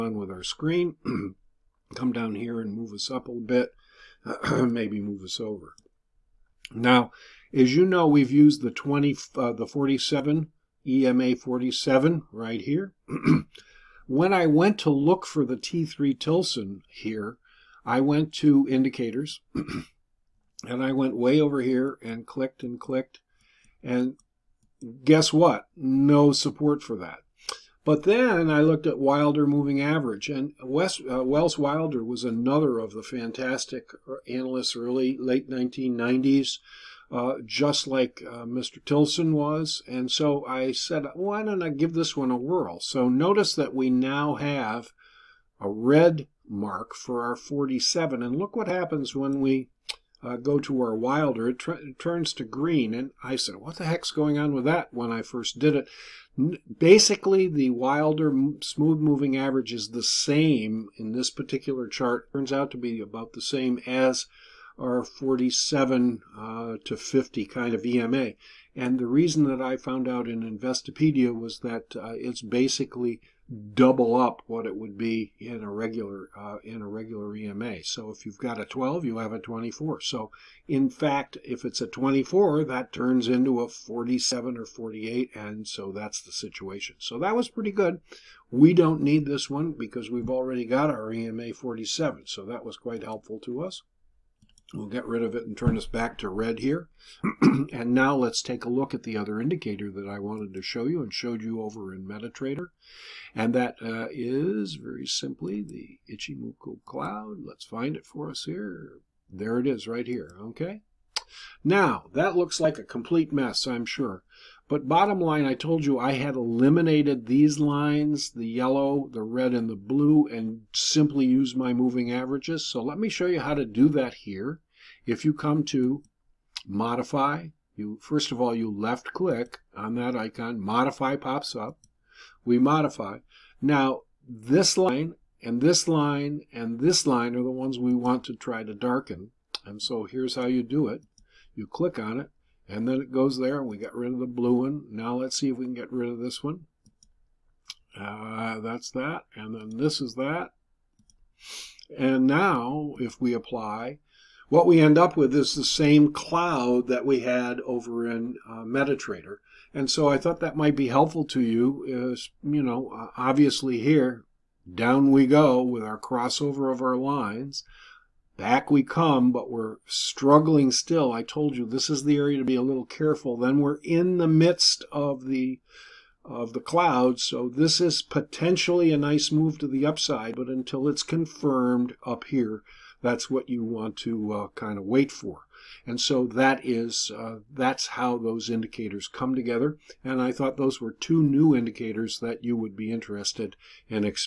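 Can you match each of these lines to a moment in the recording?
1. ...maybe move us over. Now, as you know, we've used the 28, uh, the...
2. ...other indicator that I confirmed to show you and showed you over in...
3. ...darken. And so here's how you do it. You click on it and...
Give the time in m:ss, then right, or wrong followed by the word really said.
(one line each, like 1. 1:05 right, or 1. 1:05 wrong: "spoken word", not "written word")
1. 0:04 wrong: "20", not "28"
2. 1:39 wrong: "wanted", not "confirmed"
3. 2:18 right.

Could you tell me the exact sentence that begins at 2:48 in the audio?
Back we come, but we're struggling still.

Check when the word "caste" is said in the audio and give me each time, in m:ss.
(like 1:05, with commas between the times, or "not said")
not said.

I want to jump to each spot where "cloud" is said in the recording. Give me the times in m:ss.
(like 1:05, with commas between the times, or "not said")
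1:46, 2:36, 2:56.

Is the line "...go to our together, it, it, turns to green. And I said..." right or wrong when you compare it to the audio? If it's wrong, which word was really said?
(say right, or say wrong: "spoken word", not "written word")
wrong: "wilder", not "together".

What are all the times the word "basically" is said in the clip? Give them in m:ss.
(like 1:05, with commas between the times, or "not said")
0:56, 1:12.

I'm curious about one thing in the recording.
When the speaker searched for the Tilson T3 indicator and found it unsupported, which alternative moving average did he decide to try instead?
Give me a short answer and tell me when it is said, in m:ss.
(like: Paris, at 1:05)
Wilder moving average, at 0:28.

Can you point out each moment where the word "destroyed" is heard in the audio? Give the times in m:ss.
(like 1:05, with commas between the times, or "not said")
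not said.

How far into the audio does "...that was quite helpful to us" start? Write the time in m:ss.
1:32.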